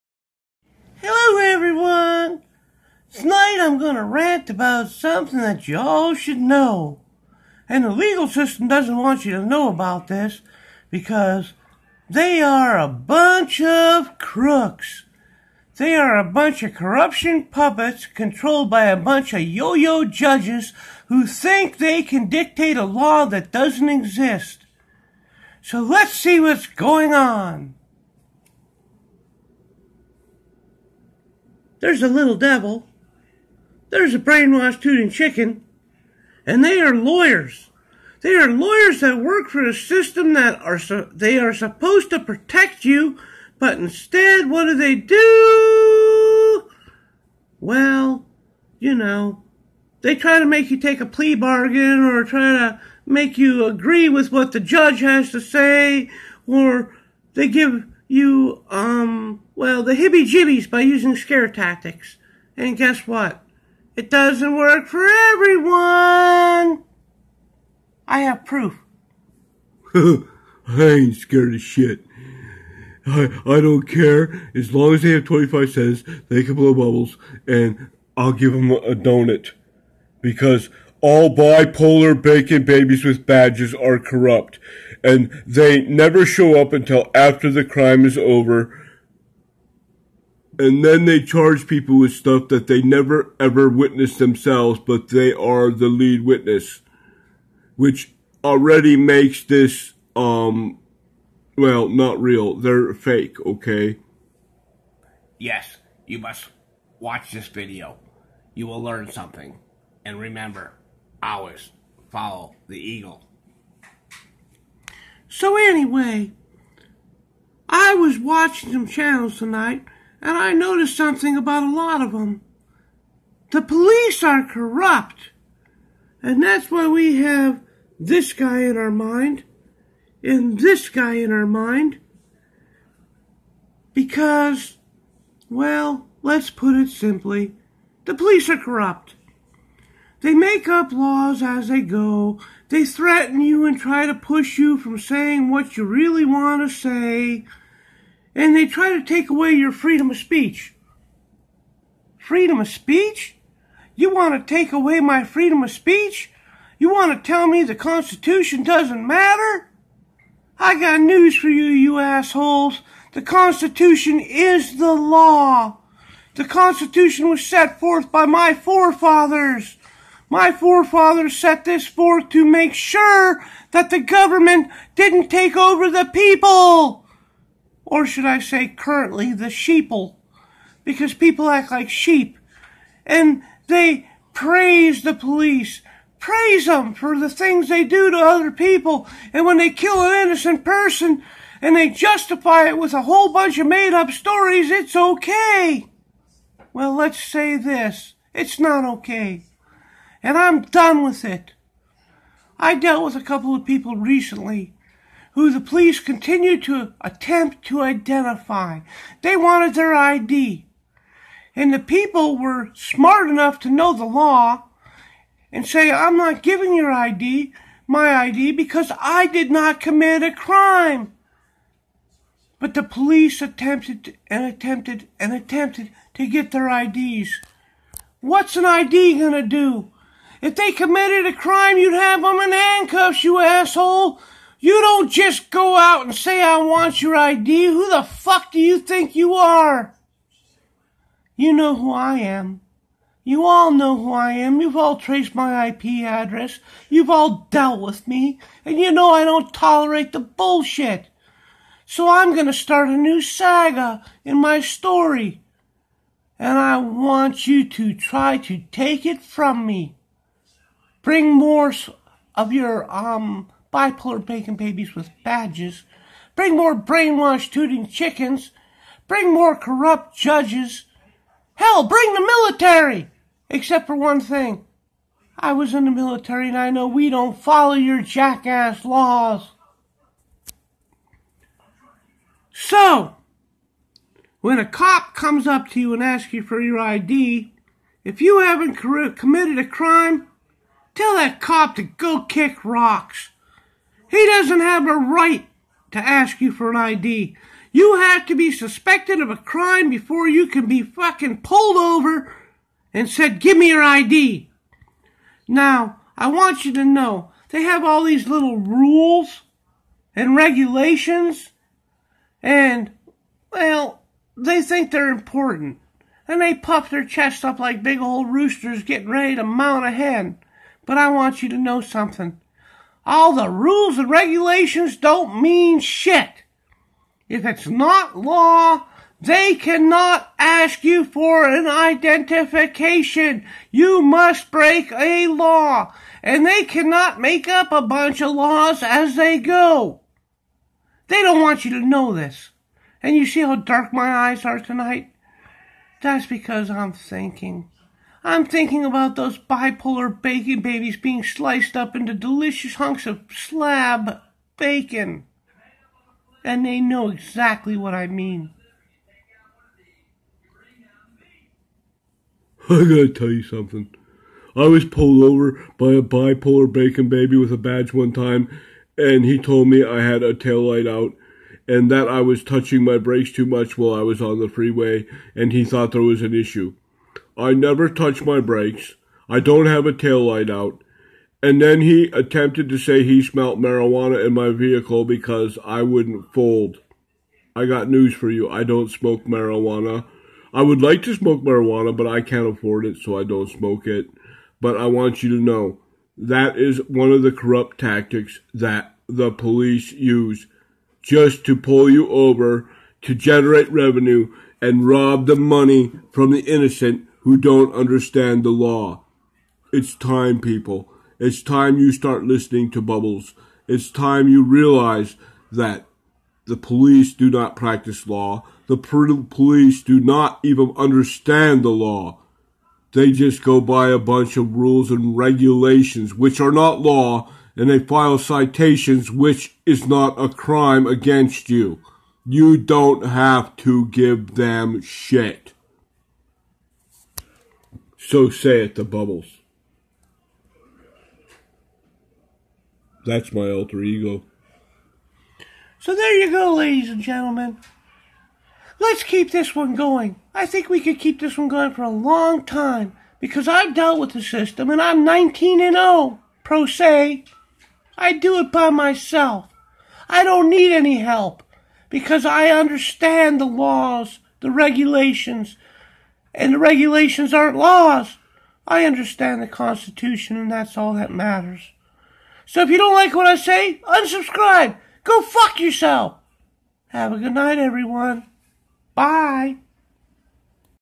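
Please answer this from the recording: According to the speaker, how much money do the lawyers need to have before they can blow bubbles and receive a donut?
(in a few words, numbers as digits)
25 cents.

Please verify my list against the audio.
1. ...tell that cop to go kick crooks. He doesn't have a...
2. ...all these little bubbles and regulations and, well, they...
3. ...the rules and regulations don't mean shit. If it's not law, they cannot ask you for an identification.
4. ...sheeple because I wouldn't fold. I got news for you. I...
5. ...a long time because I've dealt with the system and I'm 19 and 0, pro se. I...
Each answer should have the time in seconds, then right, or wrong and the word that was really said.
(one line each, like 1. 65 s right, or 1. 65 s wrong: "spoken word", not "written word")
1. 290 s wrong: "rocks", not "crooks"
2. 307 s wrong: "rules", not "bubbles"
3. 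323 s right
4. 384 s wrong: "vehicle", not "sheeple"
5. 451 s right.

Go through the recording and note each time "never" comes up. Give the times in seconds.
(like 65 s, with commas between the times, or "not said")
85 s, 92 s, 377 s.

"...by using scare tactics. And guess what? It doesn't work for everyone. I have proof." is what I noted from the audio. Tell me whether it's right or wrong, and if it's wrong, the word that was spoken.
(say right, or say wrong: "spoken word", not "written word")
right.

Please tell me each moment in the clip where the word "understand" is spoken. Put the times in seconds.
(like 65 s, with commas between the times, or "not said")
407 s, 420 s, 462 s, 468 s.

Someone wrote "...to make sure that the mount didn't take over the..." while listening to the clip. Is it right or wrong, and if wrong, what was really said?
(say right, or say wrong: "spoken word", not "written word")
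wrong: "government", not "mount".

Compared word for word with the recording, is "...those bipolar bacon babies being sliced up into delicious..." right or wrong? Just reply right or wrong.
right.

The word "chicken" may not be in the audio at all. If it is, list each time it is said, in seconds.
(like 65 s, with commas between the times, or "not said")
35 s, 267 s.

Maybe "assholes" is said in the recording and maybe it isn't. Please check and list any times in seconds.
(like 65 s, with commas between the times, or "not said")
161 s, 233 s.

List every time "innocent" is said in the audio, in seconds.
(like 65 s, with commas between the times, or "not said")
190 s, 406 s.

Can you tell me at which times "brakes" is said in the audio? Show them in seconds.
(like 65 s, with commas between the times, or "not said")
372 s, 378 s.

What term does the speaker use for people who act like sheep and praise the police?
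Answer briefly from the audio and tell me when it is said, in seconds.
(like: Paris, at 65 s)
sheeple, at 179 s.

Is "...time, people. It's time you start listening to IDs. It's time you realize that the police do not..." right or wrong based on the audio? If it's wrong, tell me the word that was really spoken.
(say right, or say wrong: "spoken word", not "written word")
wrong: "Bubbles", not "IDs".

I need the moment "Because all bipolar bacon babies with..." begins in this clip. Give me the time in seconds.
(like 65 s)
80 s.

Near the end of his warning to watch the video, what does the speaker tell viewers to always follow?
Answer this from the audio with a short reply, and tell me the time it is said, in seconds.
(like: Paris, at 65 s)
the eagle, at 112 s.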